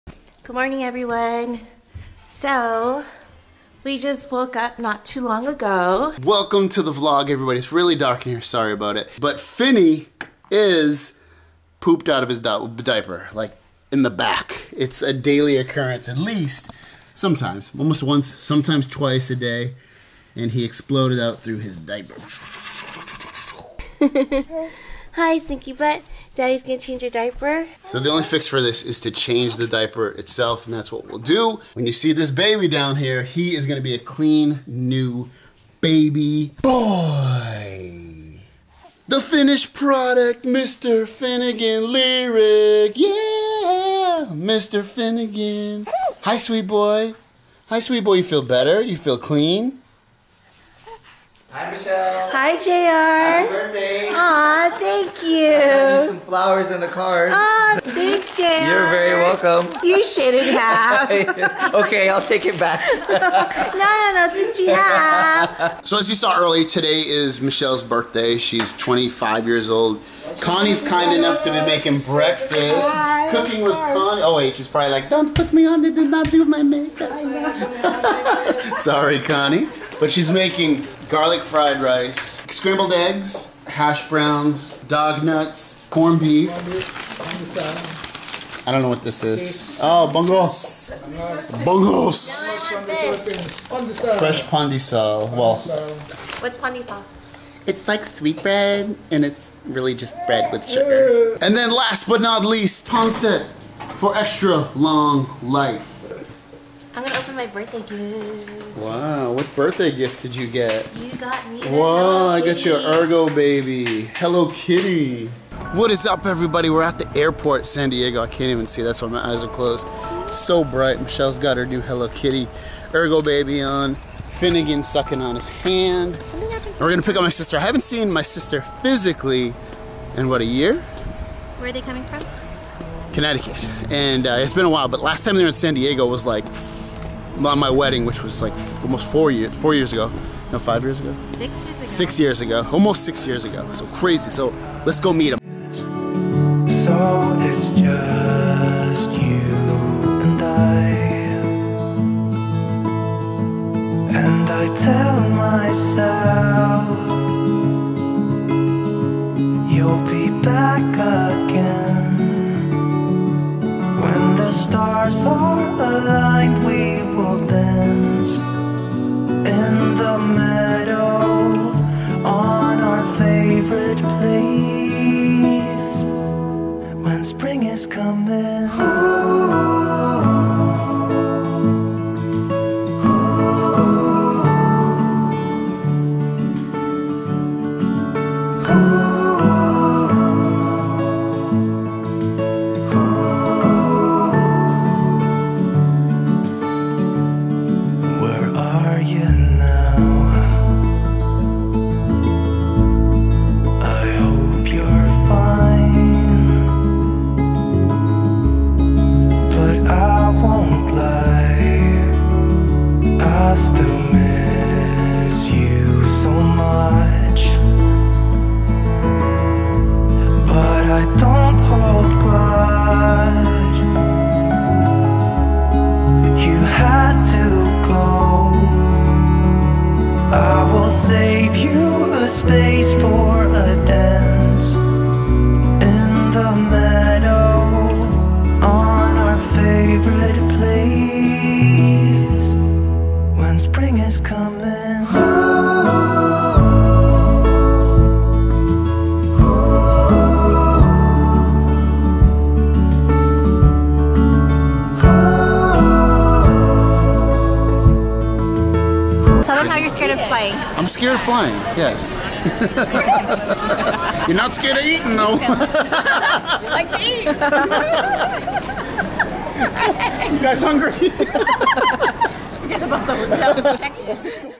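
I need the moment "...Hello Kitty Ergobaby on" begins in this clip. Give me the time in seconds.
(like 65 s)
121 s.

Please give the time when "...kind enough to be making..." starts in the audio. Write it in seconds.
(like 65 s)
70 s.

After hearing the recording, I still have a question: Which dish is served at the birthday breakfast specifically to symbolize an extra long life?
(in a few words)
pancit.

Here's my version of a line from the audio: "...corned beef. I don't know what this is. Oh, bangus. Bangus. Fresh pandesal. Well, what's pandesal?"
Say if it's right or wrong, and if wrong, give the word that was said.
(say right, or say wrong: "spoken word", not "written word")
right.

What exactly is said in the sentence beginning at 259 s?
know how you're scared of flying.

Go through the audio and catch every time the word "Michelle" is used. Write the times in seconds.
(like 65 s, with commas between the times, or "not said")
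51 s, 67 s, 121 s.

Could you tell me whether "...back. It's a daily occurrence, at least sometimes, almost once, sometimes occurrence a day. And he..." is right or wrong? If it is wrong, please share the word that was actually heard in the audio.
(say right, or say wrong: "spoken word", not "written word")
wrong: "twice", not "occurrence".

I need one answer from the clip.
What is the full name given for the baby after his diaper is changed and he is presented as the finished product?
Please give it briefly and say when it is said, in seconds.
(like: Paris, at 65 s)
Finnegan Lyric, at 41 s.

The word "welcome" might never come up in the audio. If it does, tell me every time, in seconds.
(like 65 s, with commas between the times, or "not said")
6 s, 59 s.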